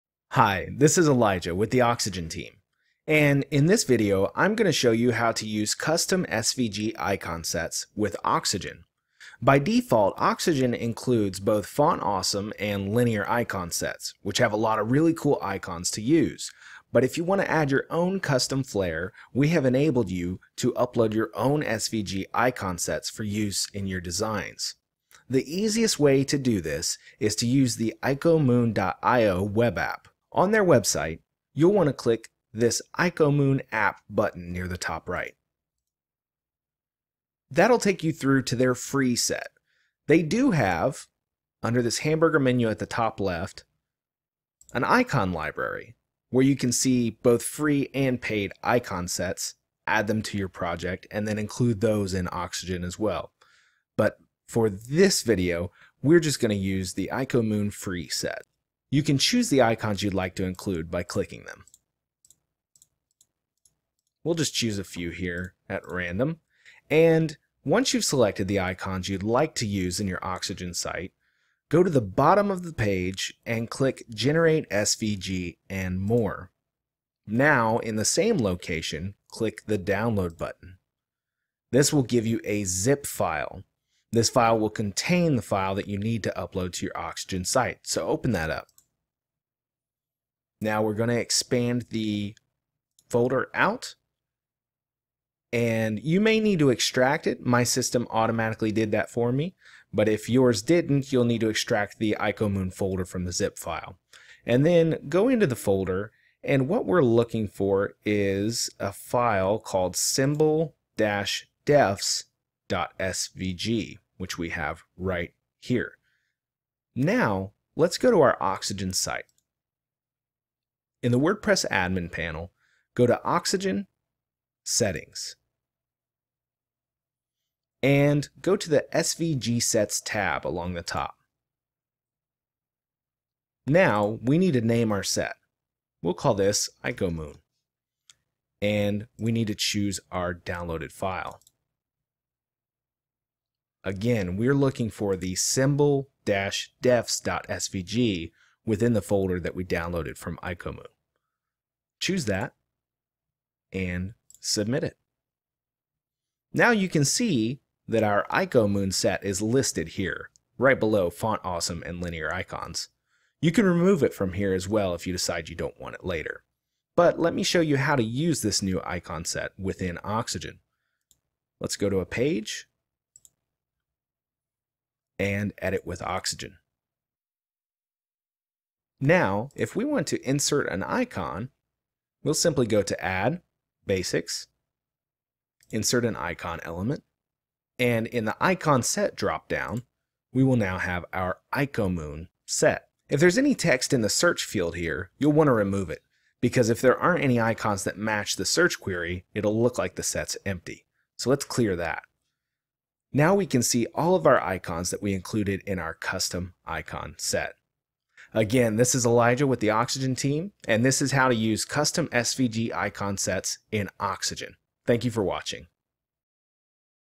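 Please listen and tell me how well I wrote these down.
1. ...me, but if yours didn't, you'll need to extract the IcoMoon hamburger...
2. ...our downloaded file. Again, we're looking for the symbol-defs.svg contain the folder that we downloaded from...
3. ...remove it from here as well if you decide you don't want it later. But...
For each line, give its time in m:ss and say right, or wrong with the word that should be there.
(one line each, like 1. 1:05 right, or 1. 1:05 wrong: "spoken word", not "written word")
1. 1:39 wrong: "folder", not "hamburger"
2. 2:20 wrong: "within", not "contain"
3. 2:43 right.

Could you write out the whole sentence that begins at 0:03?
And in this video, I'm going to show you how to use custom SVG icon sets with Oxygen.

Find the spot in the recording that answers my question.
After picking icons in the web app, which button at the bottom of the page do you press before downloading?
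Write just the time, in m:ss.
1:14.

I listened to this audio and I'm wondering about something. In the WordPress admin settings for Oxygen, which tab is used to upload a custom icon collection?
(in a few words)
SVG Sets.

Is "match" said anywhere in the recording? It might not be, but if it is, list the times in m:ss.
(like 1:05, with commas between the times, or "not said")
3:17.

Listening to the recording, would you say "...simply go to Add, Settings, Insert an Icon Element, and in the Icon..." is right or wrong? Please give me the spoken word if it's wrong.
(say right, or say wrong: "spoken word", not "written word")
wrong: "Basics", not "Settings".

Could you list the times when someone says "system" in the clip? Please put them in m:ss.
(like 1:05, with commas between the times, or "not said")
1:37.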